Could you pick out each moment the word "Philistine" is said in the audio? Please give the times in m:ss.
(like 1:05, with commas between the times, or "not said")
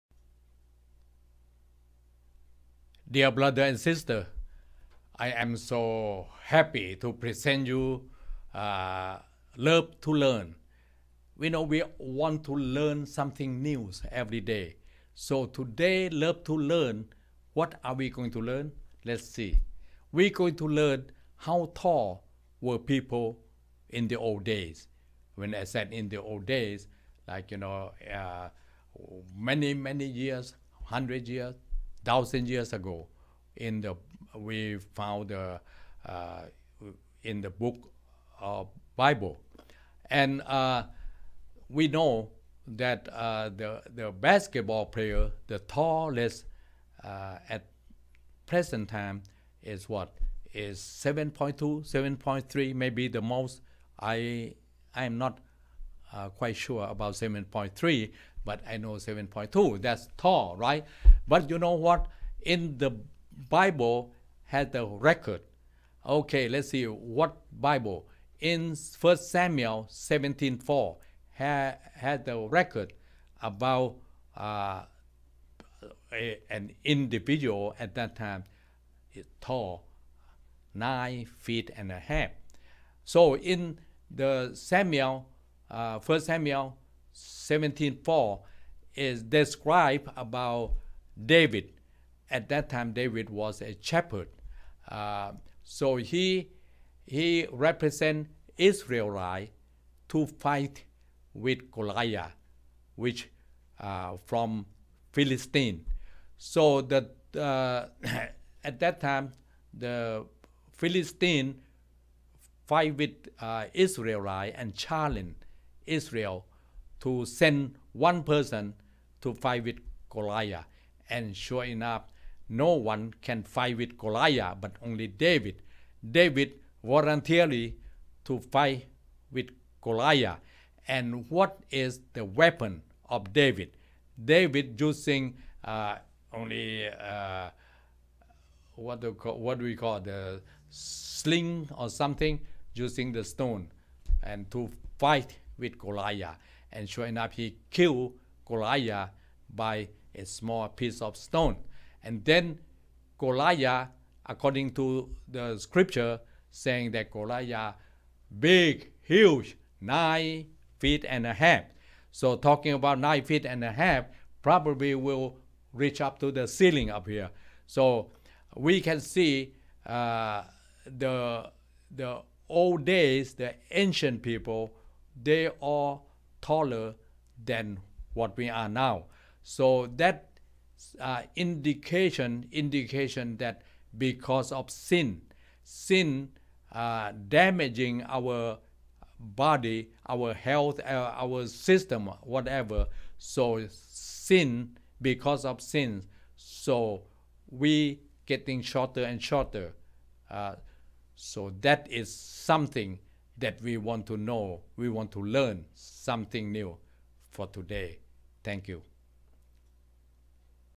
1:45, 1:50.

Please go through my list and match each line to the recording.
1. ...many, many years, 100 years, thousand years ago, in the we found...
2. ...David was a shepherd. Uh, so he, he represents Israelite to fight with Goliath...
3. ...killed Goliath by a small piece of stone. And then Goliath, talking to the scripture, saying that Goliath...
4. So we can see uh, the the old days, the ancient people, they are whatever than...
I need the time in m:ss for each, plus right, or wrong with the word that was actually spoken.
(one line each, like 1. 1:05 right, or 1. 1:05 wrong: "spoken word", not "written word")
1. 0:29 right
2. 1:32 right
3. 2:27 wrong: "according", not "talking"
4. 2:47 wrong: "taller", not "whatever".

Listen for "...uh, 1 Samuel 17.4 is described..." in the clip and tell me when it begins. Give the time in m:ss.
1:25.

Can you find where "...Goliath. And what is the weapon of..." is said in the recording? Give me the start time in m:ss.
2:09.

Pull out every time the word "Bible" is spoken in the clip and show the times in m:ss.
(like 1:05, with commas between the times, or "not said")
0:38, 1:03, 1:07.